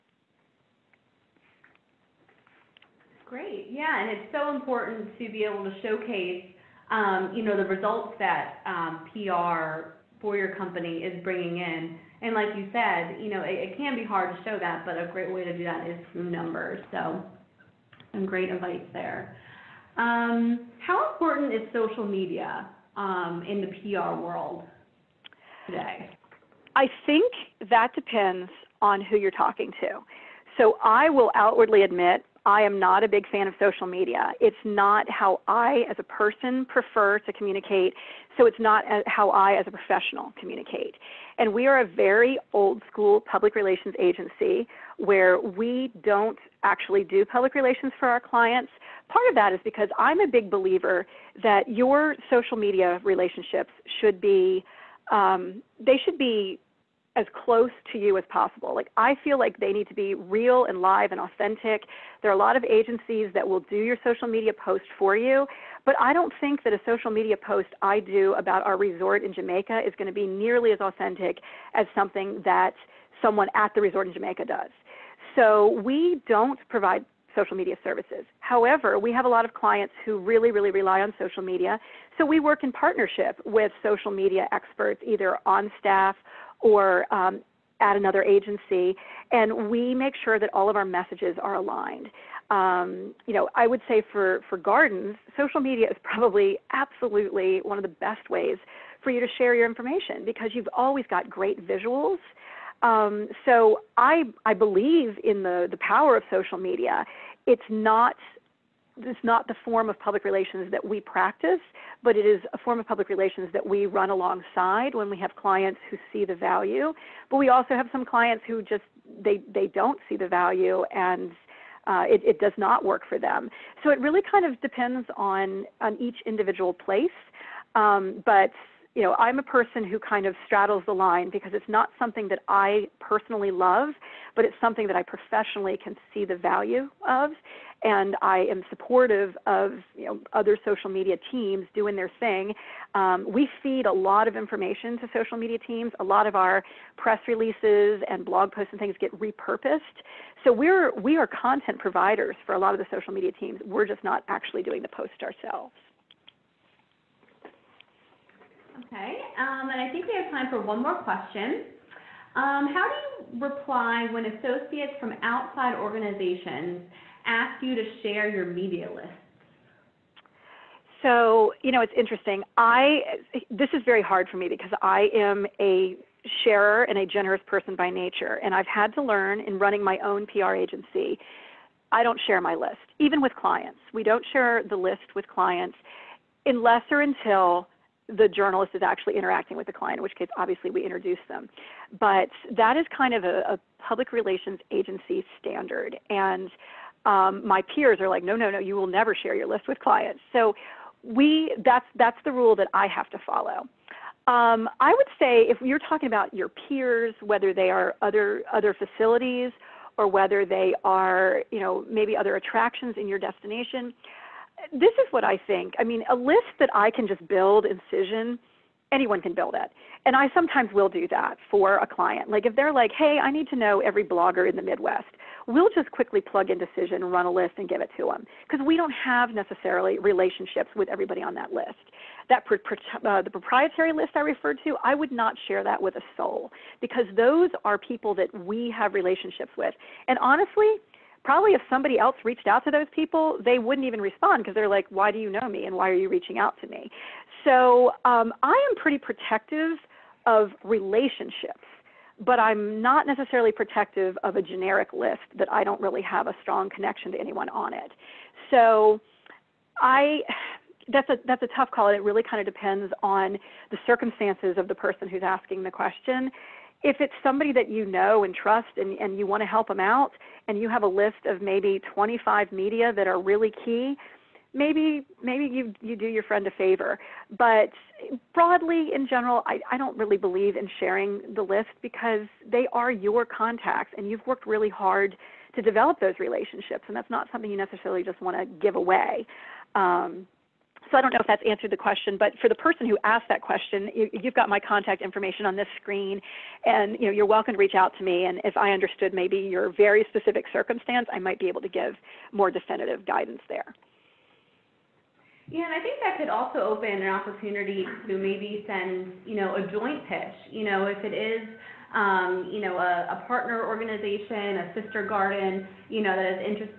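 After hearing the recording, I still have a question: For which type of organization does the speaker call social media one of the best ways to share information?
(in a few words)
gardens.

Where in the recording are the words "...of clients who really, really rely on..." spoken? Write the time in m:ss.
1:19.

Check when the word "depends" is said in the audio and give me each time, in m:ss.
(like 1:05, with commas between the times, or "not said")
0:27, 2:04, 4:22.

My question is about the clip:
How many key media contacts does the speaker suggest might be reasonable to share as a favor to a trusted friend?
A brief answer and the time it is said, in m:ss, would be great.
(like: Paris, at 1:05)
25, at 4:31.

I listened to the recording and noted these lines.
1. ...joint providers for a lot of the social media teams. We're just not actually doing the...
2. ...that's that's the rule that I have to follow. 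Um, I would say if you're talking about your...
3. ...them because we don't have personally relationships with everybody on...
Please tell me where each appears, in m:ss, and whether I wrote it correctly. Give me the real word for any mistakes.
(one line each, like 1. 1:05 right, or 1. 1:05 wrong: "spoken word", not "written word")
1. 2:31 wrong: "content", not "joint"
2. 3:21 right
3. 3:48 wrong: "necessarily", not "personally".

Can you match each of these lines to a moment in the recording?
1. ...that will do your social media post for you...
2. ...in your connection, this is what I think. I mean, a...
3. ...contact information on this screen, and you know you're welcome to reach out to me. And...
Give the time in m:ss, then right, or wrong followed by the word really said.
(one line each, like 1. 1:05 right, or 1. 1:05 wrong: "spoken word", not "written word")
1. 1:03 right
2. 3:32 wrong: "destination", not "connection"
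3. 4:54 right.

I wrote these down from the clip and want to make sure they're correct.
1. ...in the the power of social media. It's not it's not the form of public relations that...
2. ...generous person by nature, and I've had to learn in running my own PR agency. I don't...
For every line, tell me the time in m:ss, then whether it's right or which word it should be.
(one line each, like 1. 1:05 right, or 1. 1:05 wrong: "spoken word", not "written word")
1. 1:45 right
2. 2:57 right.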